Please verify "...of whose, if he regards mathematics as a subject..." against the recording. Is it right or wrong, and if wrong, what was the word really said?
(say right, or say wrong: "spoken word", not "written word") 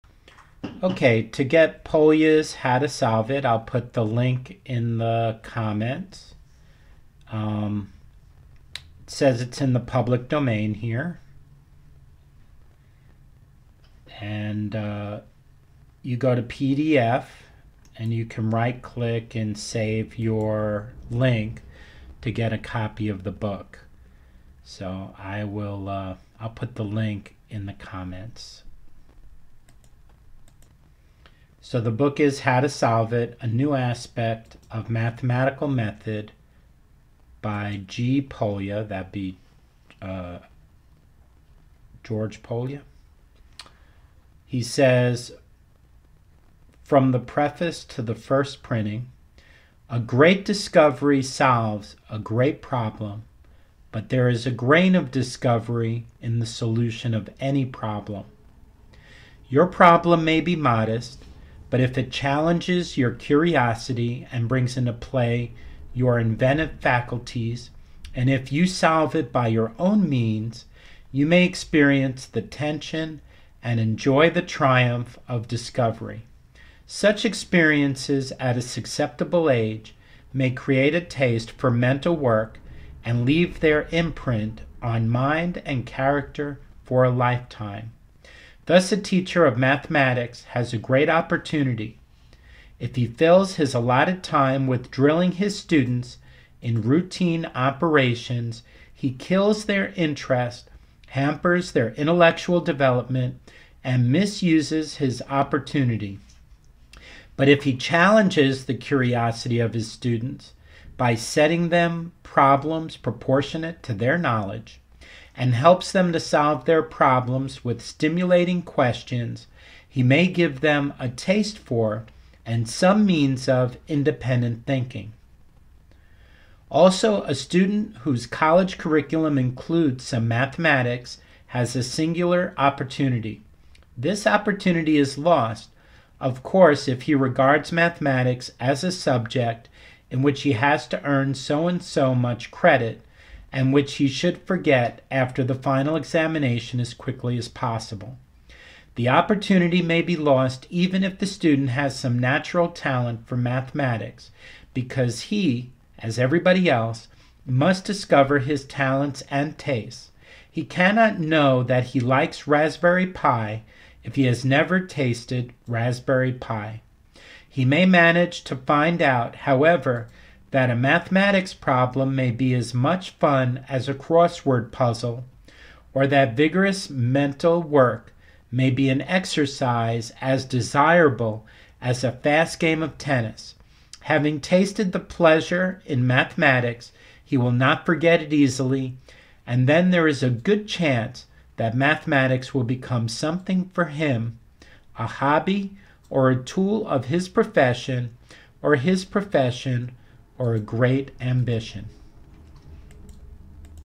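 wrong: "course", not "whose".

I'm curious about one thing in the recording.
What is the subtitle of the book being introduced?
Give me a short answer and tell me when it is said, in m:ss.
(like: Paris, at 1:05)
Mathematical Method, at 0:34.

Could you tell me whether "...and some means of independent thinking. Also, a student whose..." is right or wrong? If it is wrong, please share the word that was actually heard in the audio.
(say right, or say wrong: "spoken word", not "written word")
right.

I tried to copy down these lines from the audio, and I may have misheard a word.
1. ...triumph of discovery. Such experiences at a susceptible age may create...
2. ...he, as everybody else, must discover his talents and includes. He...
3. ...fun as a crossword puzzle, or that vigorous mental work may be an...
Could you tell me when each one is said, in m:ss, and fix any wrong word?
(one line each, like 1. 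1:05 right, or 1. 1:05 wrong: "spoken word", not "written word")
1. 1:14 right
2. 2:35 wrong: "tastes", not "includes"
3. 2:53 right.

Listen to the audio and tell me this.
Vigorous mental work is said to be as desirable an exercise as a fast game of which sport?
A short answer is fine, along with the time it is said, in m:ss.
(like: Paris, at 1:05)
Tennis, at 3:02.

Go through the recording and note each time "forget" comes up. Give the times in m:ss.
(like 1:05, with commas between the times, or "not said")
2:24, 3:07.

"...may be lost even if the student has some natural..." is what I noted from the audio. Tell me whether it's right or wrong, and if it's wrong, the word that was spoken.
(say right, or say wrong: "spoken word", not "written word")
right.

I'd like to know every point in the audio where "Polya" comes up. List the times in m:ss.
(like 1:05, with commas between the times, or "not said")
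0:01, 0:38, 0:42.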